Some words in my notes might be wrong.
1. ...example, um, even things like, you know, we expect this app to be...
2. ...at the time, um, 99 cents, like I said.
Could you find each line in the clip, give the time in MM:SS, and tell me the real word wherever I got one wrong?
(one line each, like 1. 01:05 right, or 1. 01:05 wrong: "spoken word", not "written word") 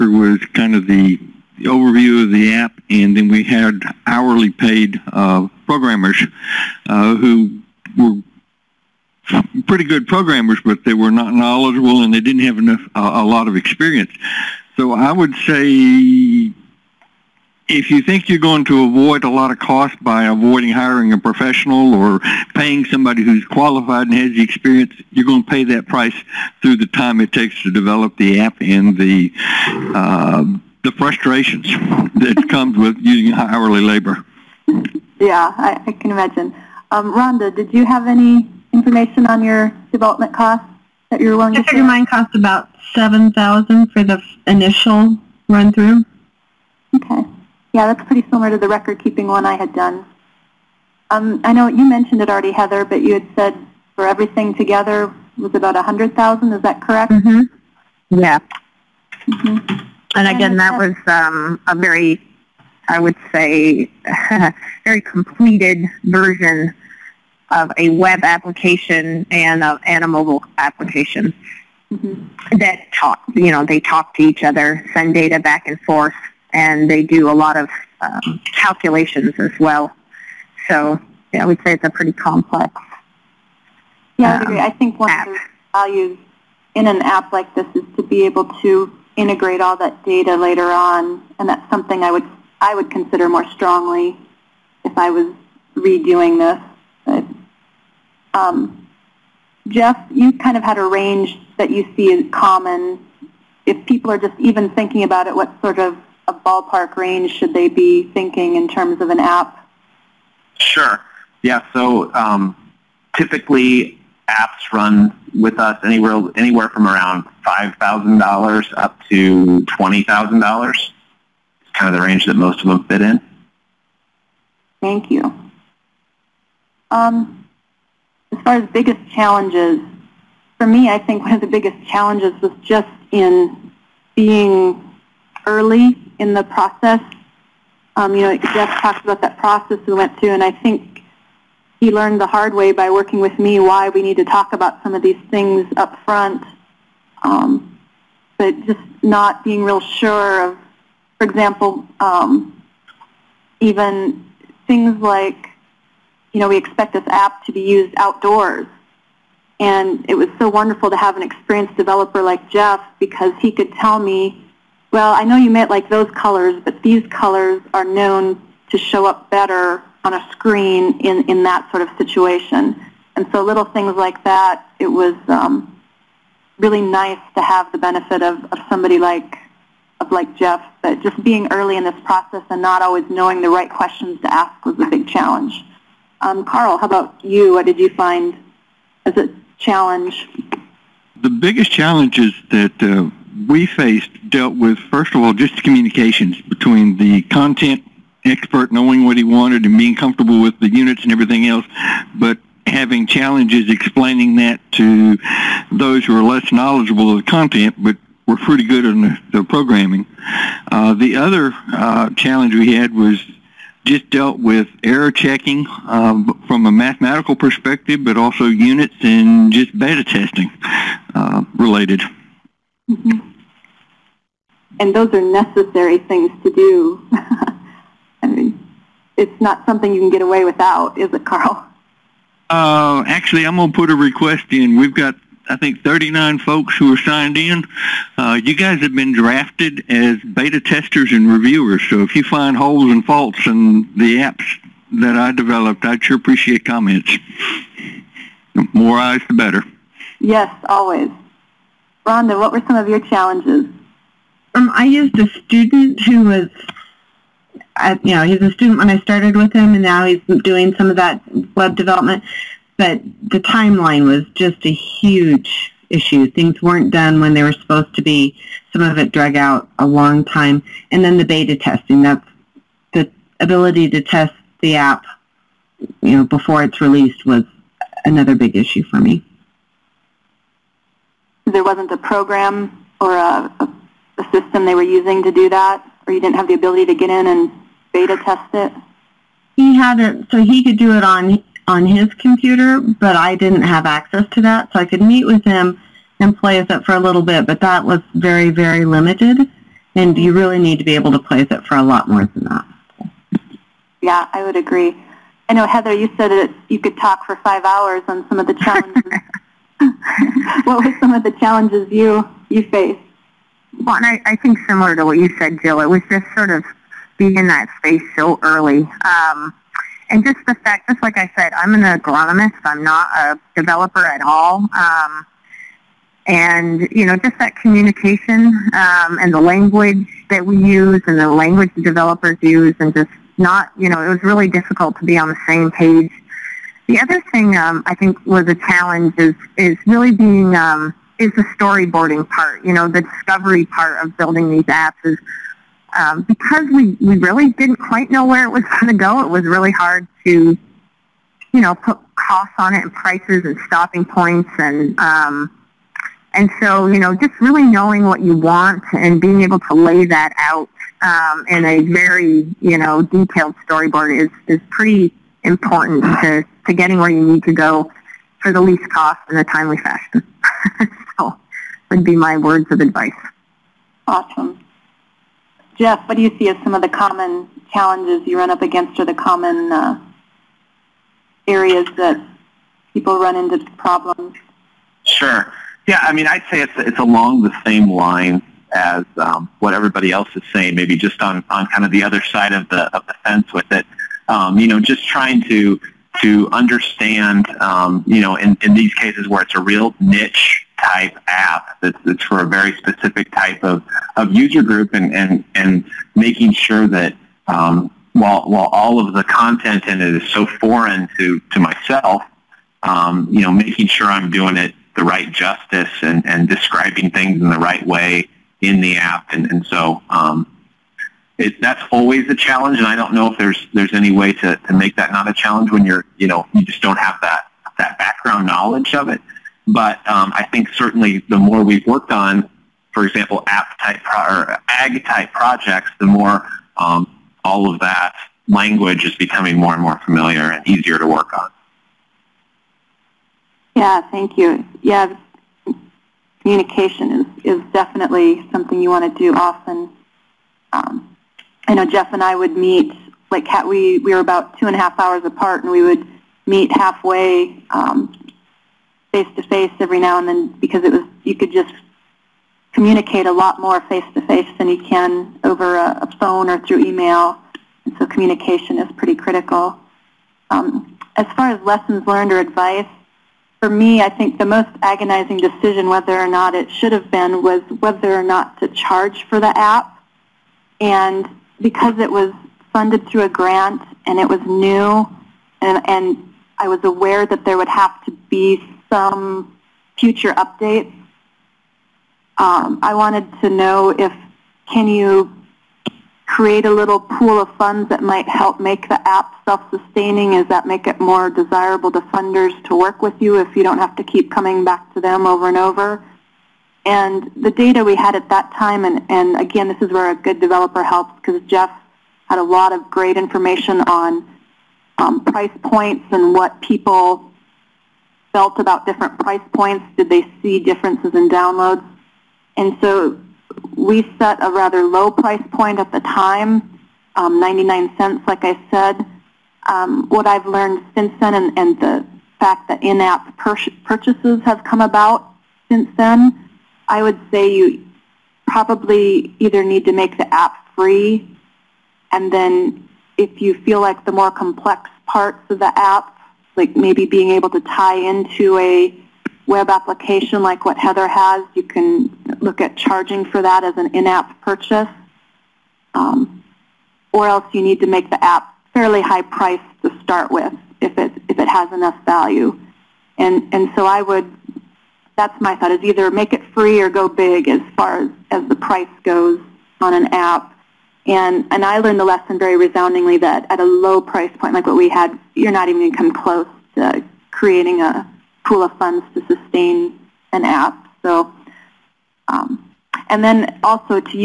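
1. 02:31 right
2. 08:45 right.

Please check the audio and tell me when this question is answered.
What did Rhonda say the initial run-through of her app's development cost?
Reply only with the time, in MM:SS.
00:42.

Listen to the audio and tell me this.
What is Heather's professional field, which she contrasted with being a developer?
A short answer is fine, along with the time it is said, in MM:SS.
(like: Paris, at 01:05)
agronomist, at 05:21.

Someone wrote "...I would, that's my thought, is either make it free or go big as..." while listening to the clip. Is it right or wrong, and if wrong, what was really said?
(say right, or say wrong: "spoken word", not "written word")
right.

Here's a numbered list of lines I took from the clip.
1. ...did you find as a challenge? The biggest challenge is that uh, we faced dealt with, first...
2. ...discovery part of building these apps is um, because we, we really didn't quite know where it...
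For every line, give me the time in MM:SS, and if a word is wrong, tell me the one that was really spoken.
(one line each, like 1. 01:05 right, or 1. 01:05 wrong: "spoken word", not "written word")
1. 03:07 right
2. 05:43 right.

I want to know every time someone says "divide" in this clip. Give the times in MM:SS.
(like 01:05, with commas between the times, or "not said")
not said.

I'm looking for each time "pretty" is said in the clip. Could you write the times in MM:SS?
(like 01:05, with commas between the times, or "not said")
00:09, 00:48, 01:21, 03:28, 06:04, 07:48.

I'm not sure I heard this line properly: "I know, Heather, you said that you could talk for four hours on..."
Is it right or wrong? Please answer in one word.
wrong.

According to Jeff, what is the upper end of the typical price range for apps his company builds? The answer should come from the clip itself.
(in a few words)
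$20,000.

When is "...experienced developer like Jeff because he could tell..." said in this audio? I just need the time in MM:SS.
02:41.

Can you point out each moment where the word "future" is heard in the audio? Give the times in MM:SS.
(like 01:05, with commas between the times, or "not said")
08:09.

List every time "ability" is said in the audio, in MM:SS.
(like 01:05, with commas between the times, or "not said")
04:33, 04:46.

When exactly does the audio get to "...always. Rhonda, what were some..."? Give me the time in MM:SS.
04:10.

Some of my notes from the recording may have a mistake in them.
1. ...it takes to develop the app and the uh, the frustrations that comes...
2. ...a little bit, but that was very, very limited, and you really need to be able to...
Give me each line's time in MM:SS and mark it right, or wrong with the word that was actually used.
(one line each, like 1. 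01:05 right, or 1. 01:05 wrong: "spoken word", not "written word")
1. 00:27 right
2. 04:56 right.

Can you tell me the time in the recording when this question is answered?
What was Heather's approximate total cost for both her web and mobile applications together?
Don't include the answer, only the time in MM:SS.
00:55.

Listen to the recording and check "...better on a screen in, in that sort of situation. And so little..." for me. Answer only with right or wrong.
right.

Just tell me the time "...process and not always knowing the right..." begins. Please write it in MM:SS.
03:02.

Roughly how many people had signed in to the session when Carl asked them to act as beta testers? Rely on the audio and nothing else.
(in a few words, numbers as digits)
39.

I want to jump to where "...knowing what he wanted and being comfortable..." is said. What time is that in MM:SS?
03:18.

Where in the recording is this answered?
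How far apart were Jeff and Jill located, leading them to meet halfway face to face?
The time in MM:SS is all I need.
07:34.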